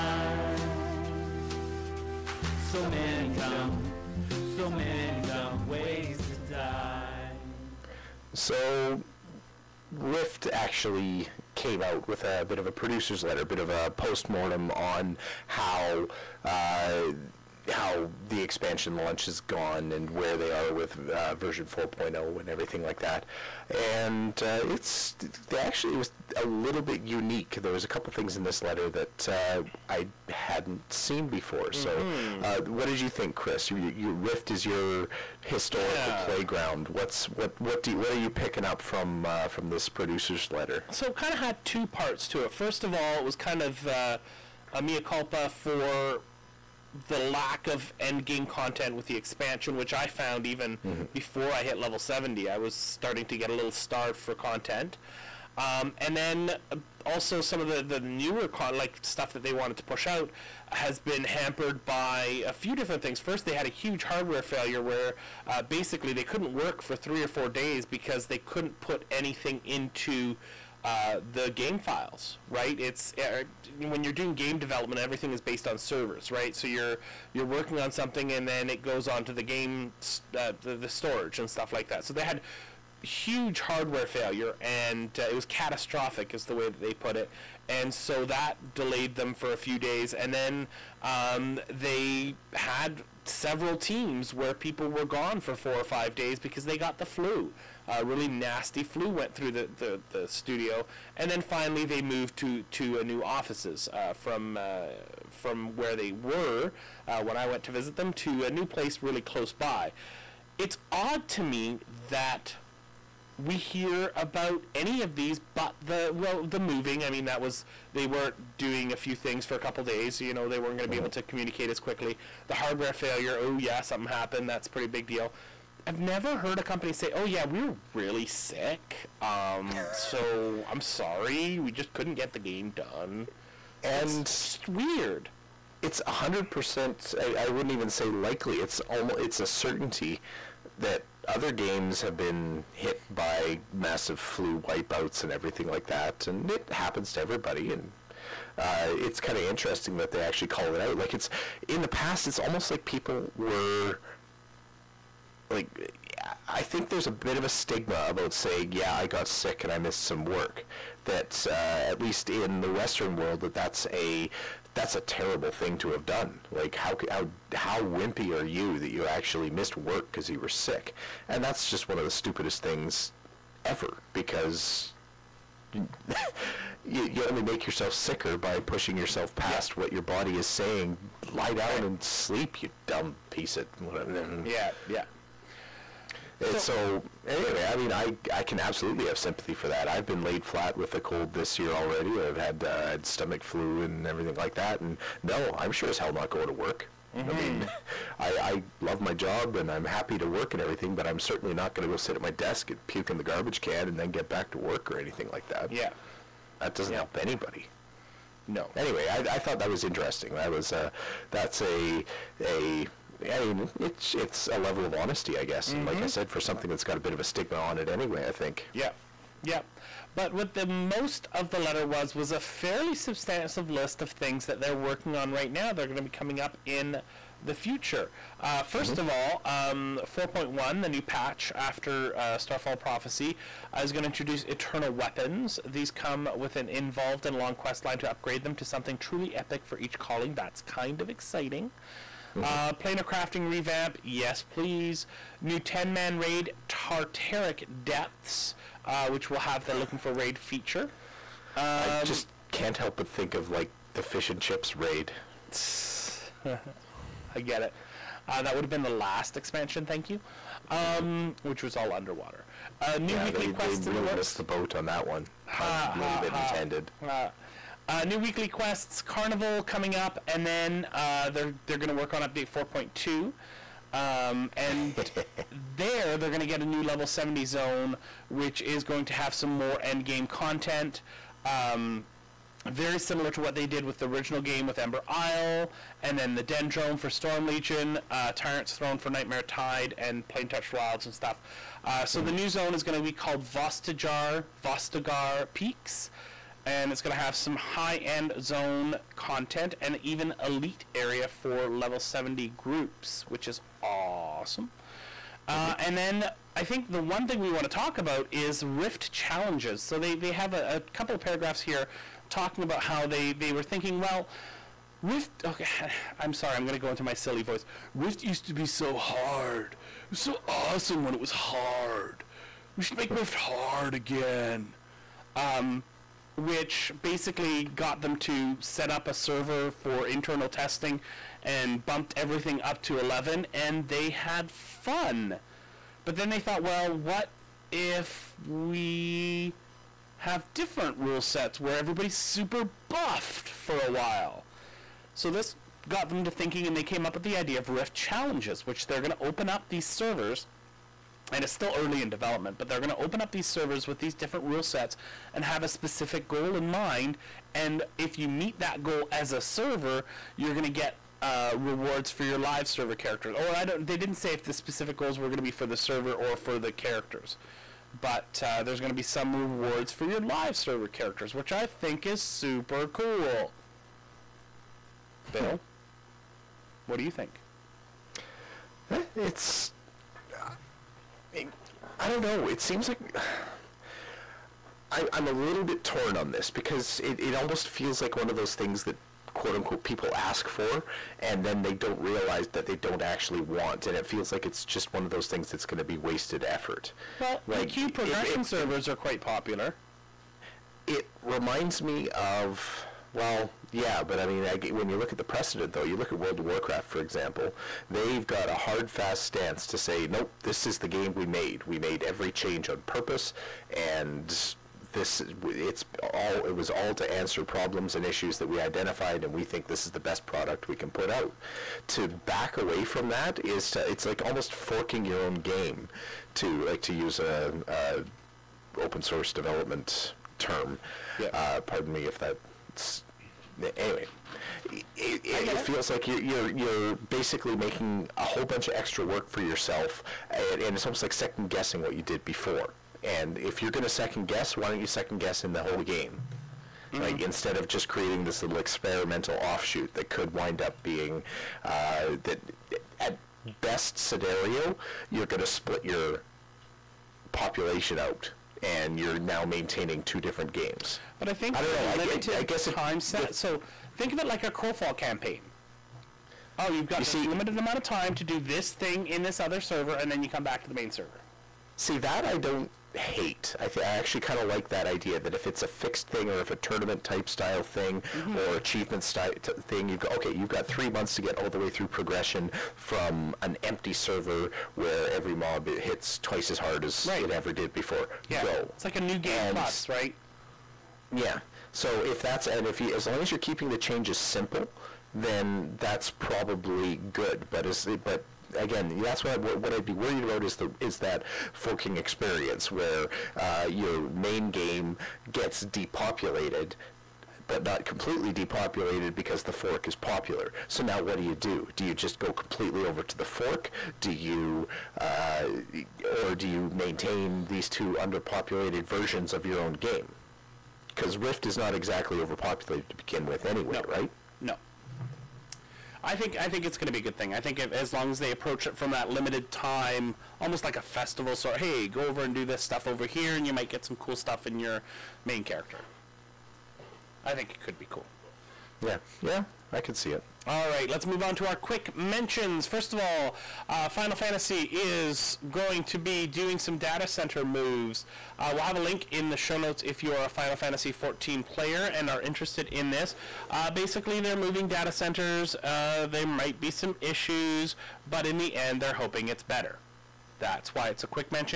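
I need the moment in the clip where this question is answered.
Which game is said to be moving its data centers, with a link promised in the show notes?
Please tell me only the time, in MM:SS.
09:10.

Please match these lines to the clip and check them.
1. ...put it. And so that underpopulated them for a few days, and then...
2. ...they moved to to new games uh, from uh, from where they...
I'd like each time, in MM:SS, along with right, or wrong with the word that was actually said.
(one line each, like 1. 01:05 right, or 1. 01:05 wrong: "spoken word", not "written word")
1. 01:26 wrong: "delayed", not "underpopulated"
2. 01:41 wrong: "offices", not "games".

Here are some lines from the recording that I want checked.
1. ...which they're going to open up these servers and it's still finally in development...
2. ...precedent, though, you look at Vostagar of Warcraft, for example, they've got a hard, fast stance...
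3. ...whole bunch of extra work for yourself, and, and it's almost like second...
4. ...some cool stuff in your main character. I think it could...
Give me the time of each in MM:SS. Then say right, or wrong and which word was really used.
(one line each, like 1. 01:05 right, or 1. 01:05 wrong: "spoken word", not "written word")
1. 05:48 wrong: "early", not "finally"
2. 06:45 wrong: "World", not "Vostagar"
3. 07:18 right
4. 08:53 right.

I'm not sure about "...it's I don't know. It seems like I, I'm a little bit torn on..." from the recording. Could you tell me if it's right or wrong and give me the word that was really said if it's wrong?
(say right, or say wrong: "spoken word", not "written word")
right.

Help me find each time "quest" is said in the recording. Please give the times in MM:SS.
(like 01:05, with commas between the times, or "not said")
03:57, 04:23, 04:28.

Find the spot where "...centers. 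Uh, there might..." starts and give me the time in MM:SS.
09:14.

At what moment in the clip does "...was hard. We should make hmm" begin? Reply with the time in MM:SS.
05:21.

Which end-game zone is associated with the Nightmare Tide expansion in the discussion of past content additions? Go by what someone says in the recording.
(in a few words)
Tyrant's Throne.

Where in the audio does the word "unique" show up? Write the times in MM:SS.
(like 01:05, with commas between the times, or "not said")
00:27.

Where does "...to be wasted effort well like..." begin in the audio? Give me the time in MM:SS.
06:35.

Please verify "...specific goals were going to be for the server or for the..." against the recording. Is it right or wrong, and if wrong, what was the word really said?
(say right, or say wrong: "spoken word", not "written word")
right.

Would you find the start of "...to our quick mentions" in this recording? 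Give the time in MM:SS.
09:01.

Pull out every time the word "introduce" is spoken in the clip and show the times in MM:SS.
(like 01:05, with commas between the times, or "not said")
03:54.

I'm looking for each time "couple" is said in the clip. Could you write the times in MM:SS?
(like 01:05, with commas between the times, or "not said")
00:27, 01:59, 05:10.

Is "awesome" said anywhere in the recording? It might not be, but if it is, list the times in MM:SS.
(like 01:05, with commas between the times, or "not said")
05:03, 05:20.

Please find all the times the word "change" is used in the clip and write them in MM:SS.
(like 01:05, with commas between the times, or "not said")
06:52, 08:13.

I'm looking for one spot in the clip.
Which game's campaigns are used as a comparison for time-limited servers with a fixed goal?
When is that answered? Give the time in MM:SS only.
07:44.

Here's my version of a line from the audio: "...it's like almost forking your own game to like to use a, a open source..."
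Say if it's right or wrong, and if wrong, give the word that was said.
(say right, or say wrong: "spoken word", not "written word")
right.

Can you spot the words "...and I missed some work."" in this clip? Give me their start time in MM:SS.
02:39.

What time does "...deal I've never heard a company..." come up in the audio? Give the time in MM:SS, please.
02:05.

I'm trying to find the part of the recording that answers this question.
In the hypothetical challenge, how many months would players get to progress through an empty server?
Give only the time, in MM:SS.
08:00.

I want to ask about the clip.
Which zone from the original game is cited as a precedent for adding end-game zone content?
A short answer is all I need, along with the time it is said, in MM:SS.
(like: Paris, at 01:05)
Ember Isle, at 04:44.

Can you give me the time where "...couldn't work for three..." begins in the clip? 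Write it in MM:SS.
01:06.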